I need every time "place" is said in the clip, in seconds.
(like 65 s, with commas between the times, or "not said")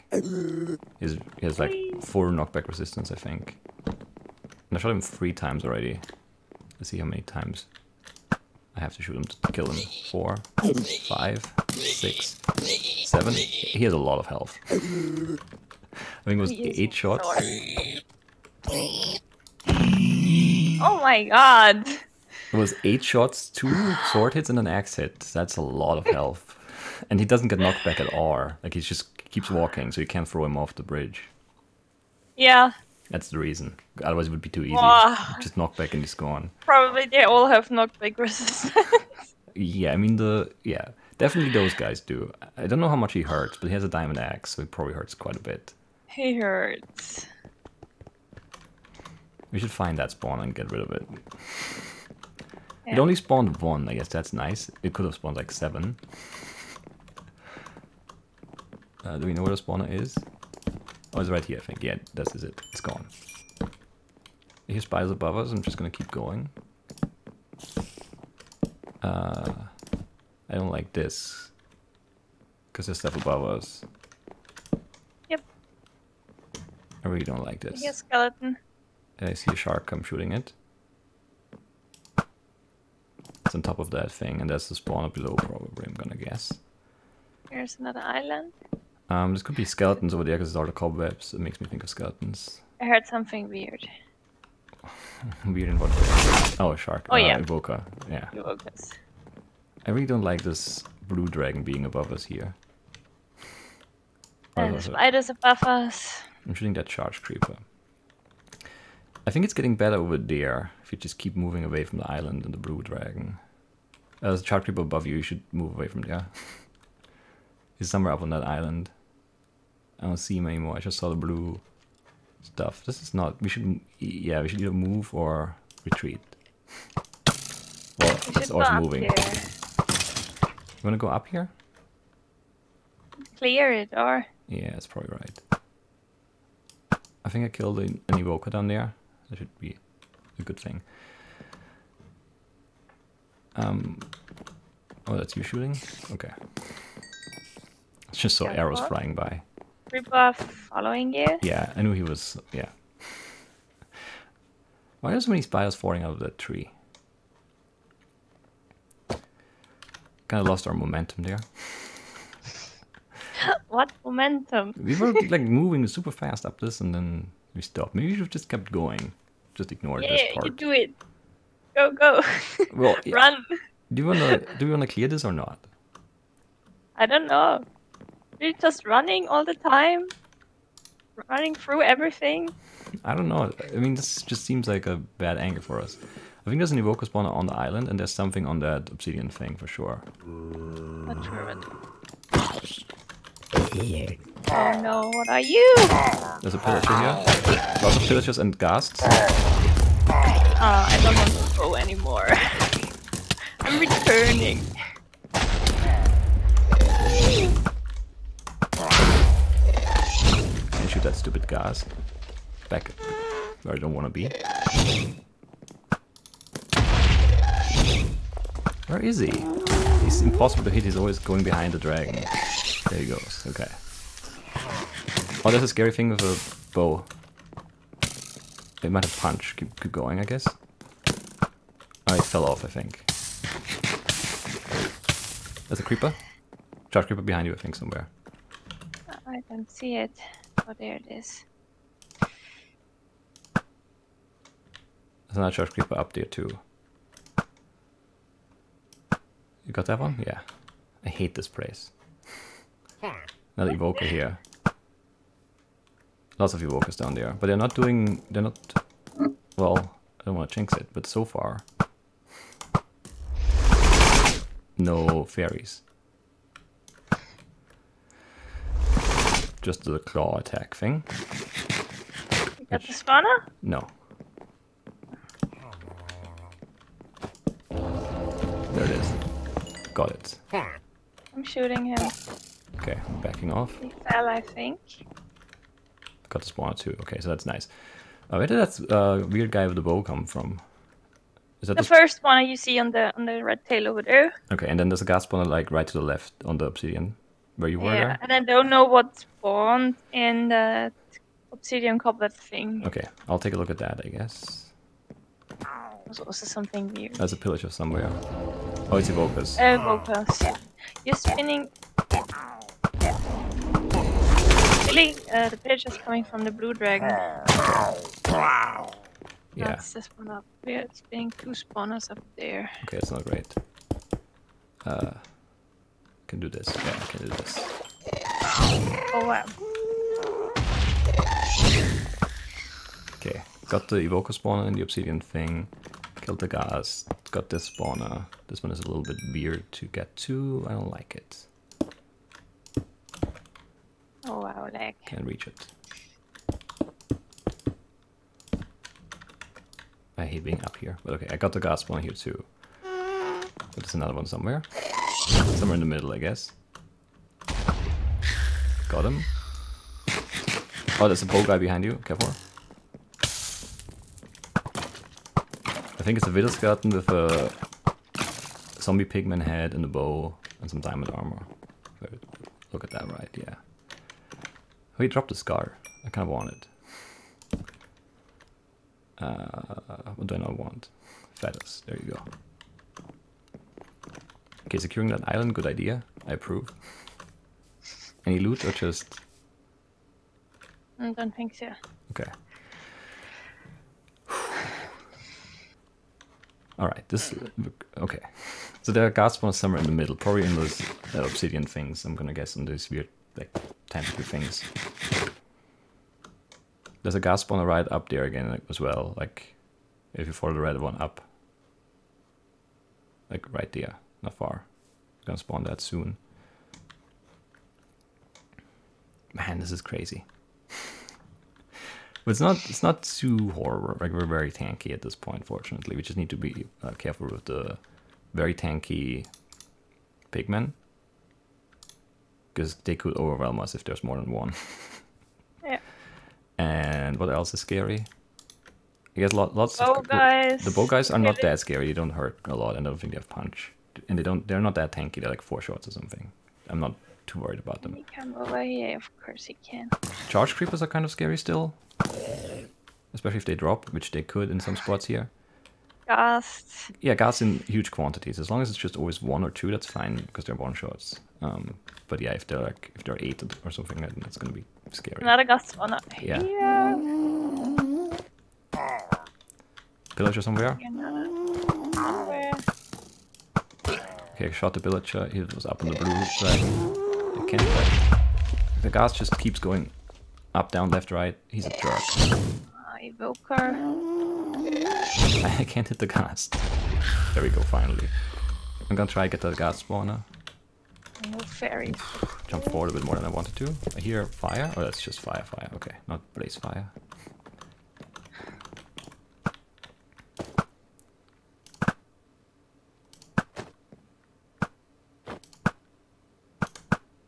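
251 s.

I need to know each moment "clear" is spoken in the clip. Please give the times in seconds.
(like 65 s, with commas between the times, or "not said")
133 s, 174 s.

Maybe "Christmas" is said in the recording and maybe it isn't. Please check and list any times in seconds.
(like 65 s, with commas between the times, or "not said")
not said.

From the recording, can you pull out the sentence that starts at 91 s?
It makes me think of skeletons.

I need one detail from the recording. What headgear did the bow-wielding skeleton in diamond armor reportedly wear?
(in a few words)
zombie pigman head.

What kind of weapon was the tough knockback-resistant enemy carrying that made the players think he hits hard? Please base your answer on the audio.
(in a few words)
diamond axe.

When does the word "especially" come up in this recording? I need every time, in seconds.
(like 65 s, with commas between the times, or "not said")
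453 s.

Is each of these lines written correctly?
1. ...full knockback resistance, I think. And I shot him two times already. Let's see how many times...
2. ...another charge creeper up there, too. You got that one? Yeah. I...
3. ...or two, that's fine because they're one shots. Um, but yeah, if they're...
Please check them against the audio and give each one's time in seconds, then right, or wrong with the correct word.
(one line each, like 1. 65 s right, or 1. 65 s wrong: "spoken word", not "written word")
1. 2 s wrong: "three", not "two"
2. 245 s right
3. 459 s right.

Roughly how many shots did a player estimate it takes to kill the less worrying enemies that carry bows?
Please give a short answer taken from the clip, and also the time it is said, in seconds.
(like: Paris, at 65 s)
4, at 445 s.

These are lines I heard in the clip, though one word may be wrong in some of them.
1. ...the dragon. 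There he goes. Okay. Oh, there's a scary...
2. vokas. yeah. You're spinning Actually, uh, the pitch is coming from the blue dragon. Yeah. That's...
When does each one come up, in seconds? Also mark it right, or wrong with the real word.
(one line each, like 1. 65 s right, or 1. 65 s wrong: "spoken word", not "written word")
1. 221 s right
2. 309 s right.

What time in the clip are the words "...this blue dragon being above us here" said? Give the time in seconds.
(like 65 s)
100 s.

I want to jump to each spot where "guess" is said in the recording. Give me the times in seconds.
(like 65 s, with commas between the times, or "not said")
53 s, 86 s, 230 s, 304 s, 356 s, 402 s, 439 s.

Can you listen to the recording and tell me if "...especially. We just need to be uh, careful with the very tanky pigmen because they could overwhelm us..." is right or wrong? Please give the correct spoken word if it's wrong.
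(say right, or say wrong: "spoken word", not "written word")
wrong: "fortunately", not "especially".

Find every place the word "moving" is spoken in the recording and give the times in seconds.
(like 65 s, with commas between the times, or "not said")
111 s, 128 s, 165 s.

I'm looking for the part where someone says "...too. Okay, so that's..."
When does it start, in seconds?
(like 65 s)
286 s.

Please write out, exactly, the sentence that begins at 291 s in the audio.
Is that the, the first one you see on the on the red tail over there?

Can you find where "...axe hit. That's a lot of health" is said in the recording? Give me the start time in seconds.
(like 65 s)
24 s.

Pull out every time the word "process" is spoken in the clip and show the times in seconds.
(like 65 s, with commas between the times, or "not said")
not said.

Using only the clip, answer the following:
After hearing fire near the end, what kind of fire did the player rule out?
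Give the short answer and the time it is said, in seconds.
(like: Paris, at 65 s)
blaze fire, at 496 s.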